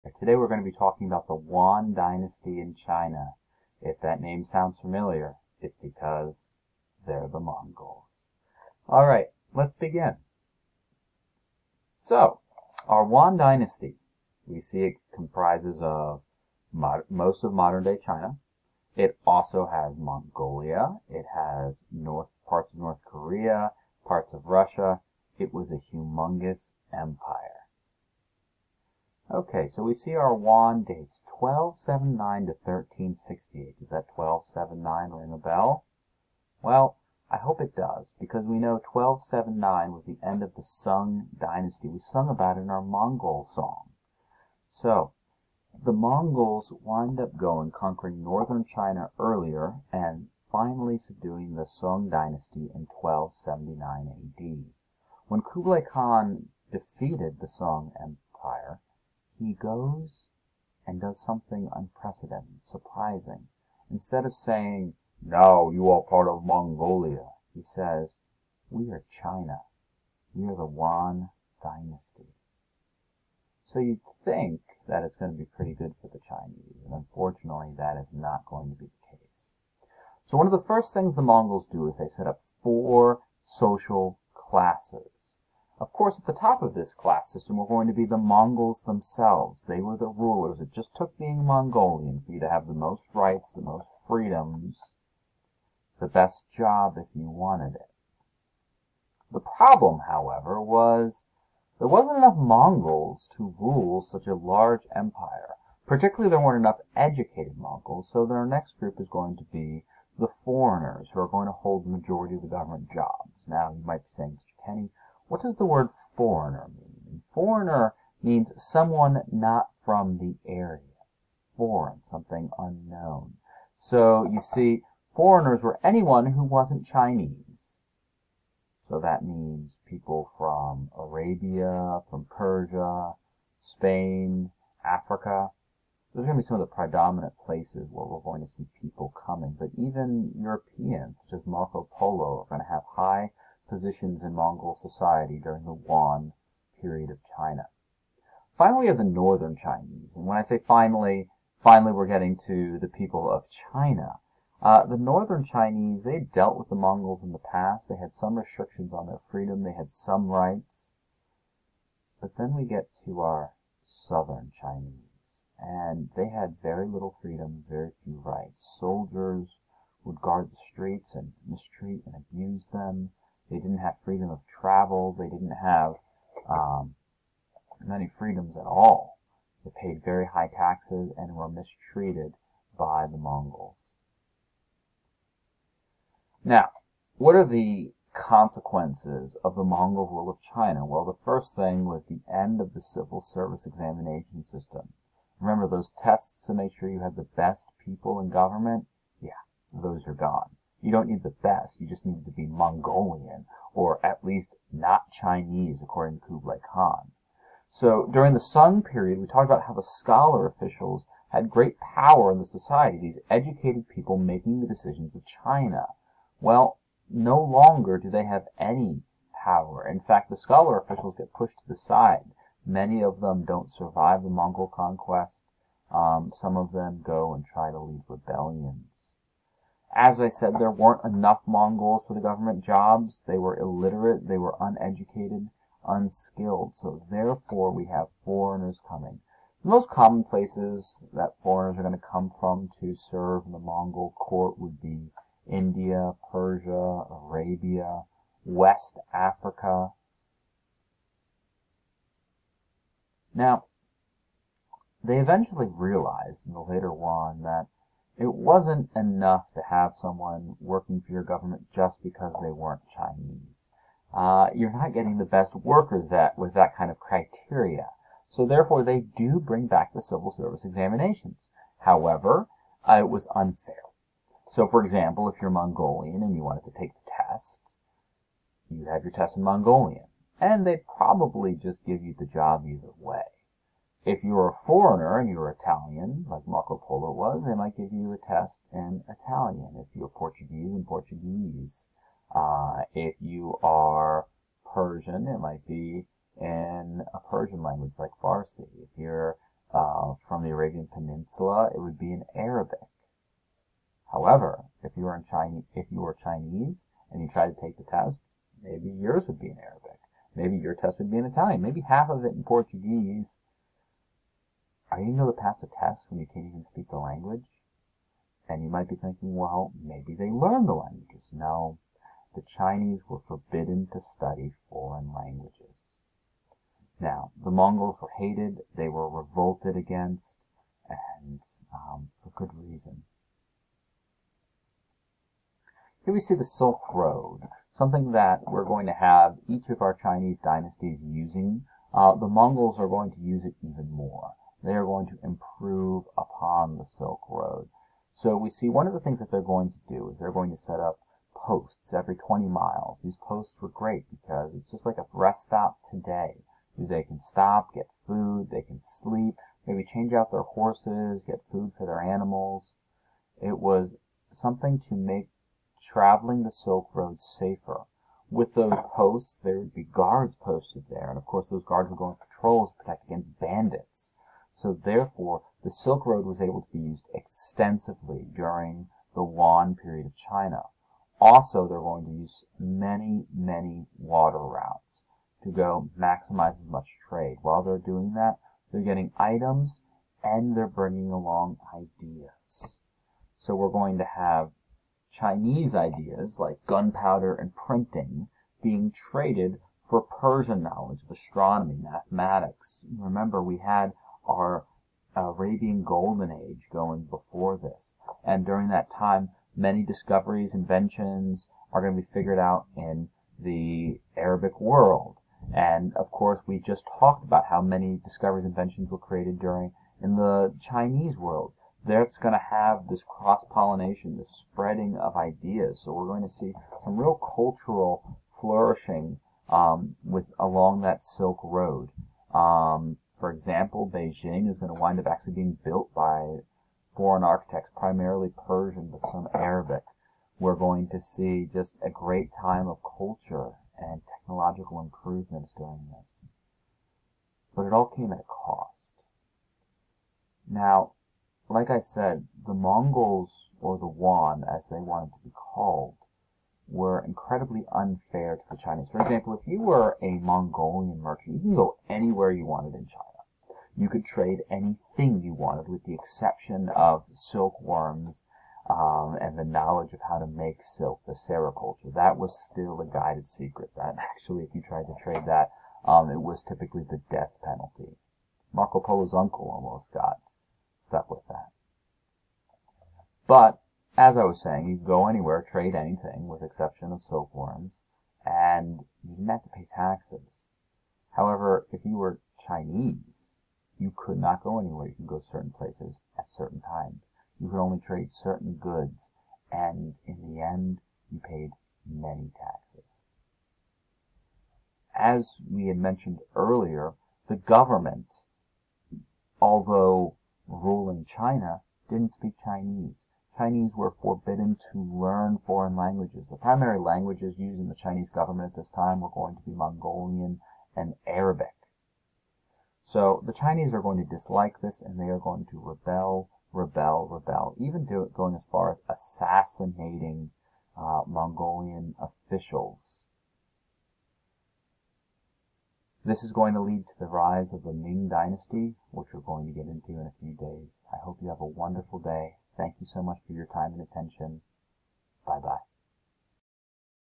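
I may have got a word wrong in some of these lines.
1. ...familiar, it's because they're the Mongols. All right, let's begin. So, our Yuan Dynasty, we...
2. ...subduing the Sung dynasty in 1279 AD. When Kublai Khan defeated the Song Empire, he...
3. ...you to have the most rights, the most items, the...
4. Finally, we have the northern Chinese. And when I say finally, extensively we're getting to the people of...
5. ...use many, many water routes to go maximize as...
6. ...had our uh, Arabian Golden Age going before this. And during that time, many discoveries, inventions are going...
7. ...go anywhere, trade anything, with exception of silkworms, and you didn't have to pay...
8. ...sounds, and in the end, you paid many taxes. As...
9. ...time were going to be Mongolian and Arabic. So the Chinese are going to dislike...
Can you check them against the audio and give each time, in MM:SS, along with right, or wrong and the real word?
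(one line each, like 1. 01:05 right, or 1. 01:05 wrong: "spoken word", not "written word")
1. 00:04 right
2. 00:50 right
3. 01:32 wrong: "freedoms", not "items"
4. 02:28 wrong: "finally", not "extensively"
5. 06:22 right
6. 06:43 right
7. 08:04 right
8. 08:18 wrong: "goods", not "sounds"
9. 08:38 right.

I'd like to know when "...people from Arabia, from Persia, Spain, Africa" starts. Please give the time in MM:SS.
02:09.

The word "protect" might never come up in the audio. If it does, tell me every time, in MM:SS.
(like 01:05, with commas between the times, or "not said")
06:12.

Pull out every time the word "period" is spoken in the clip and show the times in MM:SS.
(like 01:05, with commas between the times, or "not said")
02:26, 03:28, 06:19.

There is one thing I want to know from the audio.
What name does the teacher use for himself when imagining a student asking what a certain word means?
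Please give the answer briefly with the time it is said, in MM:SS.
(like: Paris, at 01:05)
Mr. Kenny, at 01:54.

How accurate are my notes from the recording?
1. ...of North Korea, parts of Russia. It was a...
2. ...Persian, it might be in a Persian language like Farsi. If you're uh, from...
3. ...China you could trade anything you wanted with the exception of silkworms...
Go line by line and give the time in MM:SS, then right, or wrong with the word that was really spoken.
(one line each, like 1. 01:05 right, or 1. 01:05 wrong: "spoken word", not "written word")
1. 00:22 right
2. 04:54 right
3. 07:42 right.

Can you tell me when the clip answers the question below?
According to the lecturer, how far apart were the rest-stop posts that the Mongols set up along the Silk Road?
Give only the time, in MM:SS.
05:52.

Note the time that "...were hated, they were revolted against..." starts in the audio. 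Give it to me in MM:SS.
05:28.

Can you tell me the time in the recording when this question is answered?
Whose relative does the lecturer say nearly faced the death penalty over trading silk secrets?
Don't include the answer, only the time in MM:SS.
07:58.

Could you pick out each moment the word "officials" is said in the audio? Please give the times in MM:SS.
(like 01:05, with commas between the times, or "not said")
03:30, 03:40, 08:52.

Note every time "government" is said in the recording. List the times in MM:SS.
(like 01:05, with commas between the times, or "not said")
01:52, 03:18, 03:52, 04:21, 08:27, 08:38.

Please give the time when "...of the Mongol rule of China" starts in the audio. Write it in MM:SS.
03:09.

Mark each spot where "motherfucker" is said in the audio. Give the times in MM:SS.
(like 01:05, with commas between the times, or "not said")
not said.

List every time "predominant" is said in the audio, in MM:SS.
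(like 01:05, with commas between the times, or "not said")
02:16.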